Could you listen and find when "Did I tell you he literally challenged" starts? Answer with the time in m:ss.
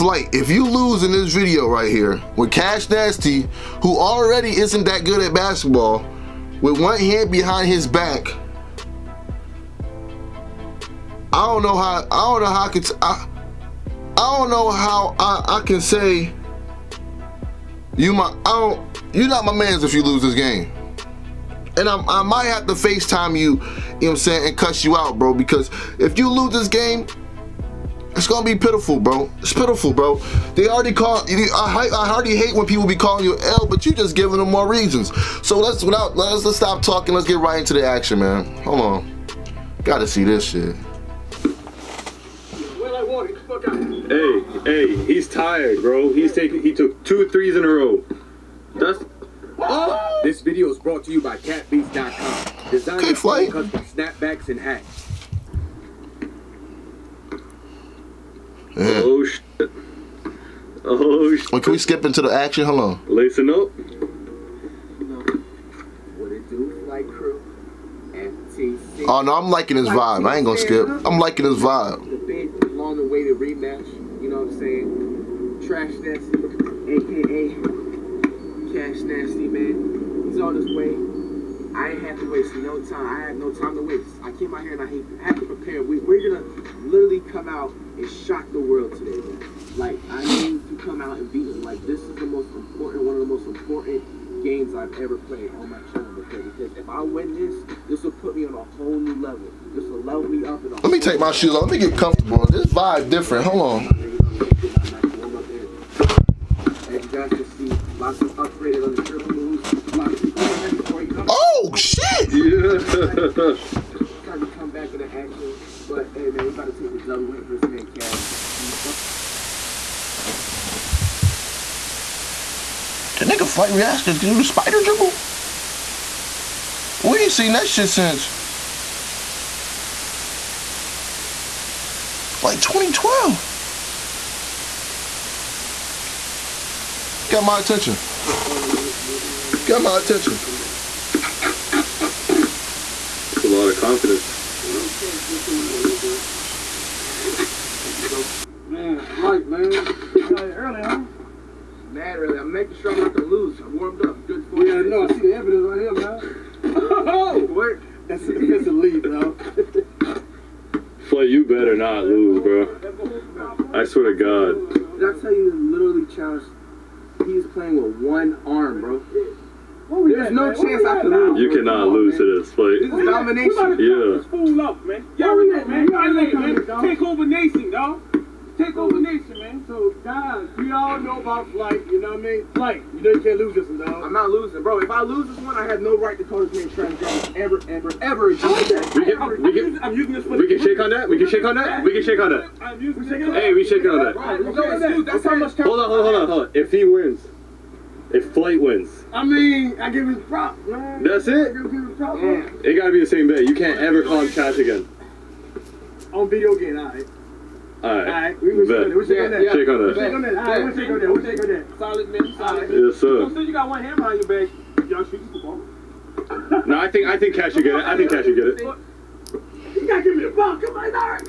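2:44.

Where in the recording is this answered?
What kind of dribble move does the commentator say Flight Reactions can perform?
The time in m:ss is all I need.
2:04.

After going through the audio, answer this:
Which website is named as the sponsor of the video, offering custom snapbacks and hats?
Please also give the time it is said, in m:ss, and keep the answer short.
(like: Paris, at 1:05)
CapBeast.com, at 0:51.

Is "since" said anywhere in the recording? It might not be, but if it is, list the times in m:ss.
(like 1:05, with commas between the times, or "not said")
2:07, 3:33.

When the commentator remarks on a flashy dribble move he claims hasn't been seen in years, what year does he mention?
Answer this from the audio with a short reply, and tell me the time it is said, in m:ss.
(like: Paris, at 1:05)
2012, at 2:12.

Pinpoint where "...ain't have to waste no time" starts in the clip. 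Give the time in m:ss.
1:21.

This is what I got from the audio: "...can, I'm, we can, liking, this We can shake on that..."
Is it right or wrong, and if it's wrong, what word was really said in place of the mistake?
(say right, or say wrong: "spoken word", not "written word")
wrong: "using", not "liking".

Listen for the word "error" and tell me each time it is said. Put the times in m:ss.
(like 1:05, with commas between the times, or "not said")
not said.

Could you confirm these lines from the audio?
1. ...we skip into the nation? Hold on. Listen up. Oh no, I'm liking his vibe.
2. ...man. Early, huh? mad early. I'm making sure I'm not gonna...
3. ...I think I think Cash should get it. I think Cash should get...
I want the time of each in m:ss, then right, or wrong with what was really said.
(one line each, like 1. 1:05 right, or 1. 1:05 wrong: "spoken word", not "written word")
1. 1:01 wrong: "action", not "nation"
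2. 2:29 right
3. 3:36 right.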